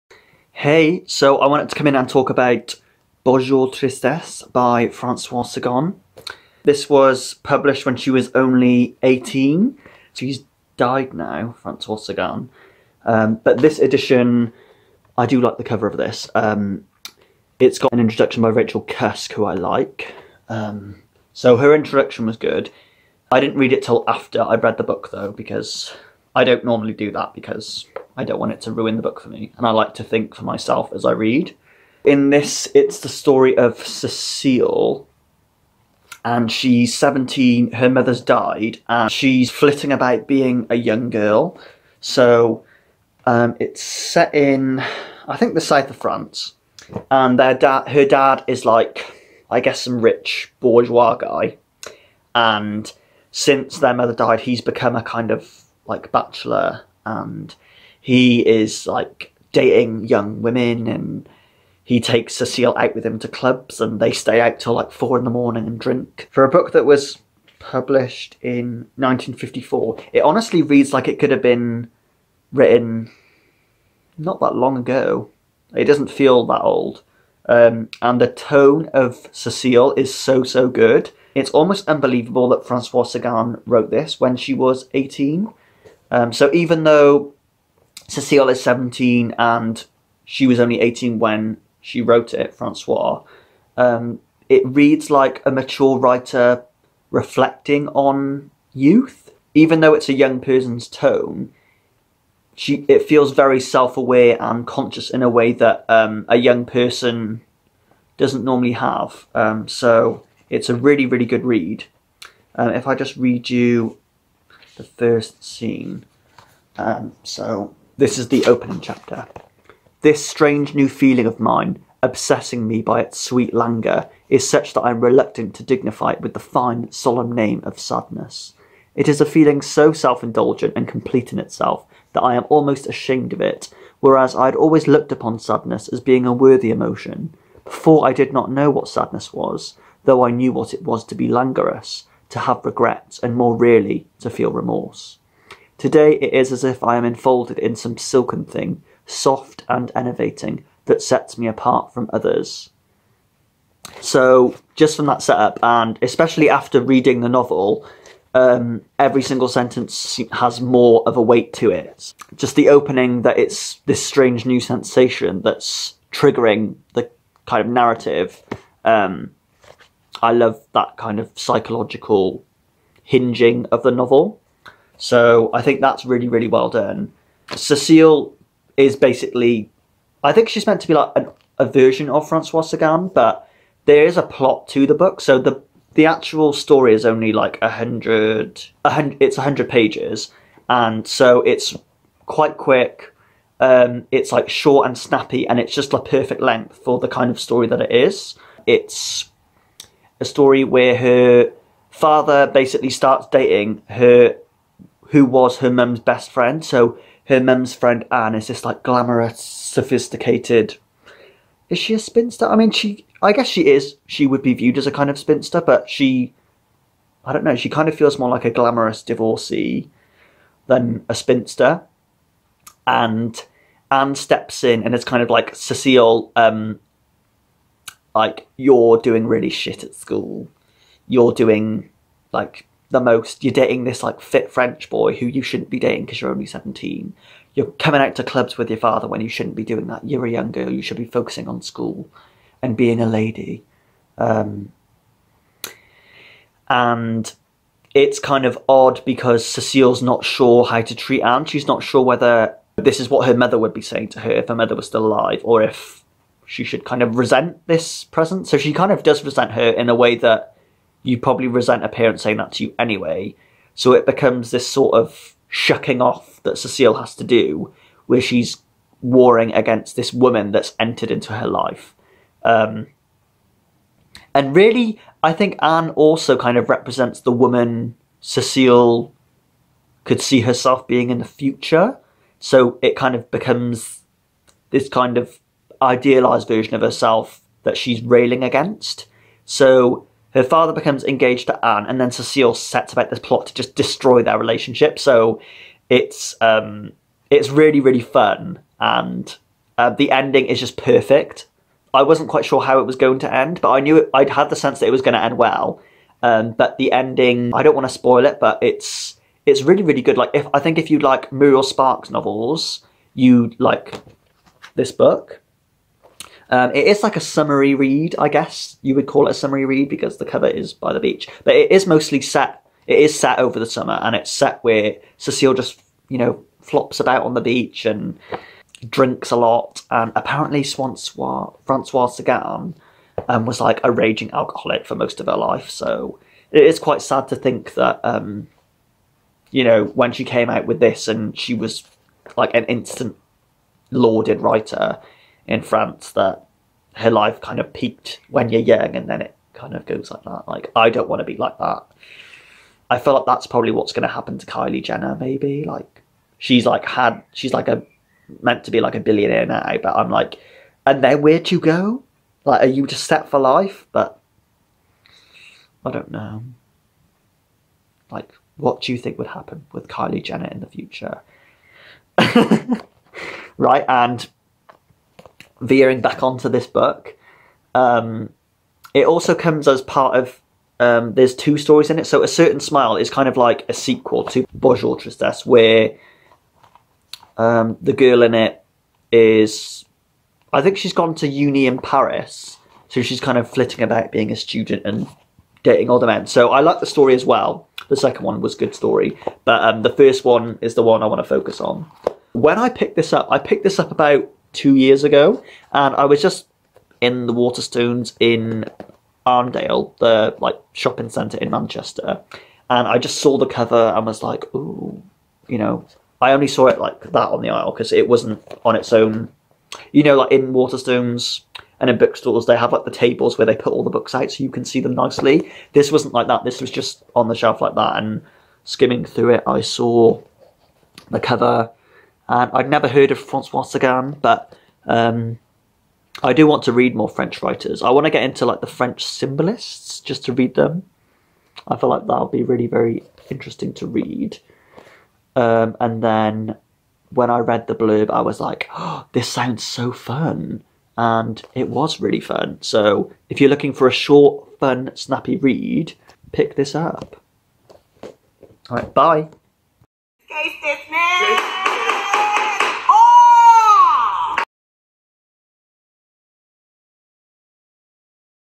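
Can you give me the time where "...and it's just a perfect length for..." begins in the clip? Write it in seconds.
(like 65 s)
195 s.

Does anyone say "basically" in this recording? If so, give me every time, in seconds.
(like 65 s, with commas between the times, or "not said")
178 s, 202 s.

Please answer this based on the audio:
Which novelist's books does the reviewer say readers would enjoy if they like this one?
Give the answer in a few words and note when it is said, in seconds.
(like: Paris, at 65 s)
Muriel Spark, at 311 s.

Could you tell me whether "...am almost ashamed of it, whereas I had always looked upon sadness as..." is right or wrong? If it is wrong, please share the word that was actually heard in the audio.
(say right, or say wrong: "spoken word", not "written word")
right.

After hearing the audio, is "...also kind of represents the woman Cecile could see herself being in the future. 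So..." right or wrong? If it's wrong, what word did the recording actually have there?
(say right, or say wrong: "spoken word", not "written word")
right.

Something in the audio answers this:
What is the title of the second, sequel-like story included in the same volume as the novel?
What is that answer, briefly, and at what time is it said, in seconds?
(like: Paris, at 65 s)
A Certain Smile, at 382 s.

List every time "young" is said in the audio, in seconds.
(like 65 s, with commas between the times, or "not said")
40 s, 60 s, 100 s, 106 s, 240 s, 348 s.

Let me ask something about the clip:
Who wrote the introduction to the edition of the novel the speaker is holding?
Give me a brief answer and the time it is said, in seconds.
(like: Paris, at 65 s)
Rachel Cusk, at 18 s.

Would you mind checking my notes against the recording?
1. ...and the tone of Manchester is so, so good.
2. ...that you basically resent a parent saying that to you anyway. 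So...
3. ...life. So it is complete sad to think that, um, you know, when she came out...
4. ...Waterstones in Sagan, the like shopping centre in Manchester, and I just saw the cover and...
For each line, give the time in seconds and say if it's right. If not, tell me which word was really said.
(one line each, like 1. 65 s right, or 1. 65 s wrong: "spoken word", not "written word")
1. 78 s wrong: "Cecile", not "Manchester"
2. 260 s wrong: "probably", not "basically"
3. 335 s wrong: "quite", not "complete"
4. 407 s wrong: "Arndale", not "Sagan".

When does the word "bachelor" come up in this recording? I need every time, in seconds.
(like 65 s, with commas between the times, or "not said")
56 s.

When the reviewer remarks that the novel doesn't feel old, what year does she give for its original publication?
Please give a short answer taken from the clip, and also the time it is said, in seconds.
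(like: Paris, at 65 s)
1954, at 68 s.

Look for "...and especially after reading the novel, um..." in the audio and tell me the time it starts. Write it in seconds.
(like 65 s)
155 s.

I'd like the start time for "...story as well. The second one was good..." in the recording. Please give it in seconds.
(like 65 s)
396 s.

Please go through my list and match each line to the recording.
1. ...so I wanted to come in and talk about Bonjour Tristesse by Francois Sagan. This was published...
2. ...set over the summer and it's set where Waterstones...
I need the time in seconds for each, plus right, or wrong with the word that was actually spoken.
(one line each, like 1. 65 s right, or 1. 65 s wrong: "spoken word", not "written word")
1. 1 s right
2. 323 s wrong: "Cecile", not "Waterstones".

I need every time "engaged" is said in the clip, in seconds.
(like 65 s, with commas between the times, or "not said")
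291 s.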